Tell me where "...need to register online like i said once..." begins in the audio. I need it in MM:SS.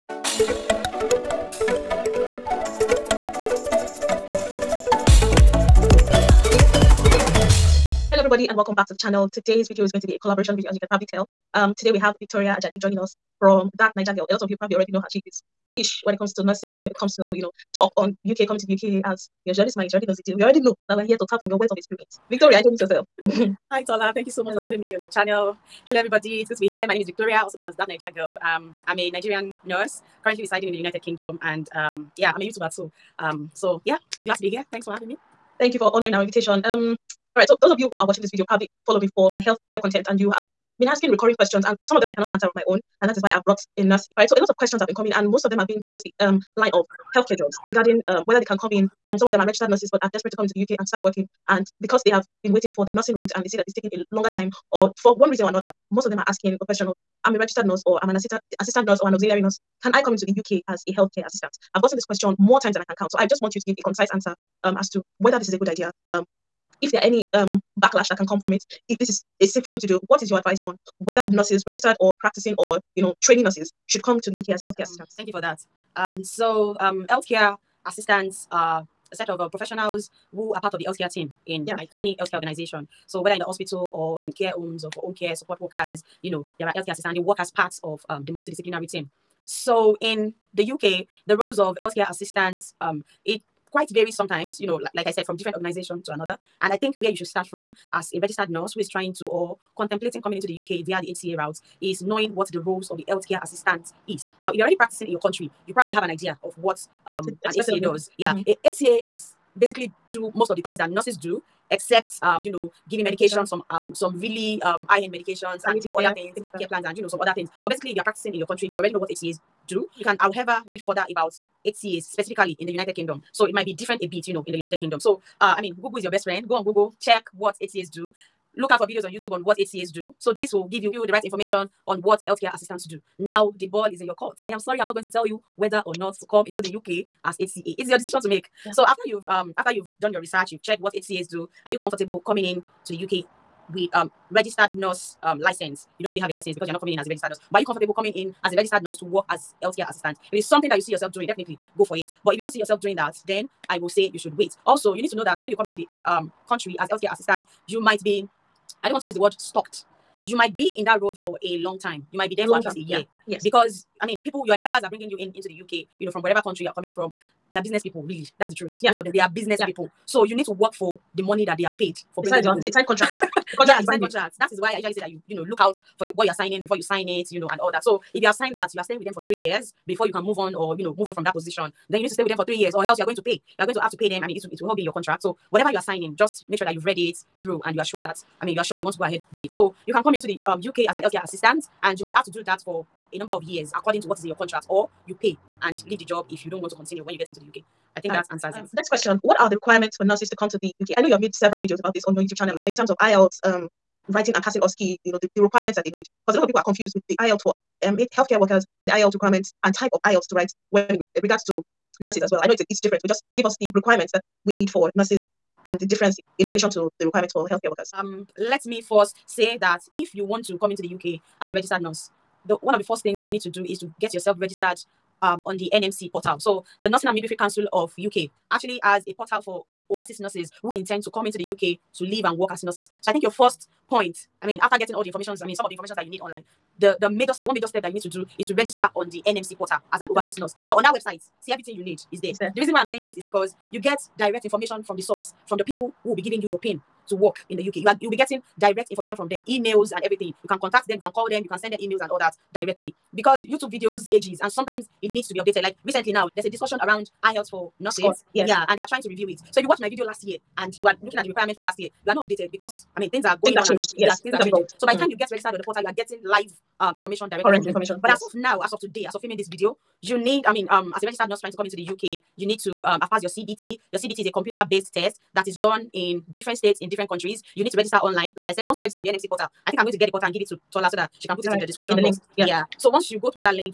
04:37.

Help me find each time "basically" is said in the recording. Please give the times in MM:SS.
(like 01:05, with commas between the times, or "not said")
01:49, 01:57.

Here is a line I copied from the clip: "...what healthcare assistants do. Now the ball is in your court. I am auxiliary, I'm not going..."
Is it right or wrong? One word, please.
wrong.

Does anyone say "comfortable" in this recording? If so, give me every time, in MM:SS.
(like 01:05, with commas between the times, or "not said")
02:21, 02:27.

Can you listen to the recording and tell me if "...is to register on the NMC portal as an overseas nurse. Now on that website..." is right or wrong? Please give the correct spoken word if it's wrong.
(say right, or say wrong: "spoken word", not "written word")
right.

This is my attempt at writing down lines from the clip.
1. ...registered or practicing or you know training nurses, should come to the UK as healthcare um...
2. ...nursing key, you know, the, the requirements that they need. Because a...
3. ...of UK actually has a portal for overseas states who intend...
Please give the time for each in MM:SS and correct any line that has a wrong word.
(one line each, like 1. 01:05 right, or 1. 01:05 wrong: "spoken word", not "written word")
1. 01:11 right
2. 03:24 wrong: "passing", not "nursing"
3. 03:47 wrong: "nurses", not "states".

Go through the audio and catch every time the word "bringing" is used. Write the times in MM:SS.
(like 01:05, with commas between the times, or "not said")
02:44, 02:52.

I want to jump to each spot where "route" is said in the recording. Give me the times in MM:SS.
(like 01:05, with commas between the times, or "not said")
00:53, 01:41.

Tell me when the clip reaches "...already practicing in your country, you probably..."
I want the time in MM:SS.
01:44.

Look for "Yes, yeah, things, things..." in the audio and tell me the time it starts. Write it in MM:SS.
04:23.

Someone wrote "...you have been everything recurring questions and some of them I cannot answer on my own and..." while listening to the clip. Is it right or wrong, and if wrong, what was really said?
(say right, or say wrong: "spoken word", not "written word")
wrong: "asking", not "everything".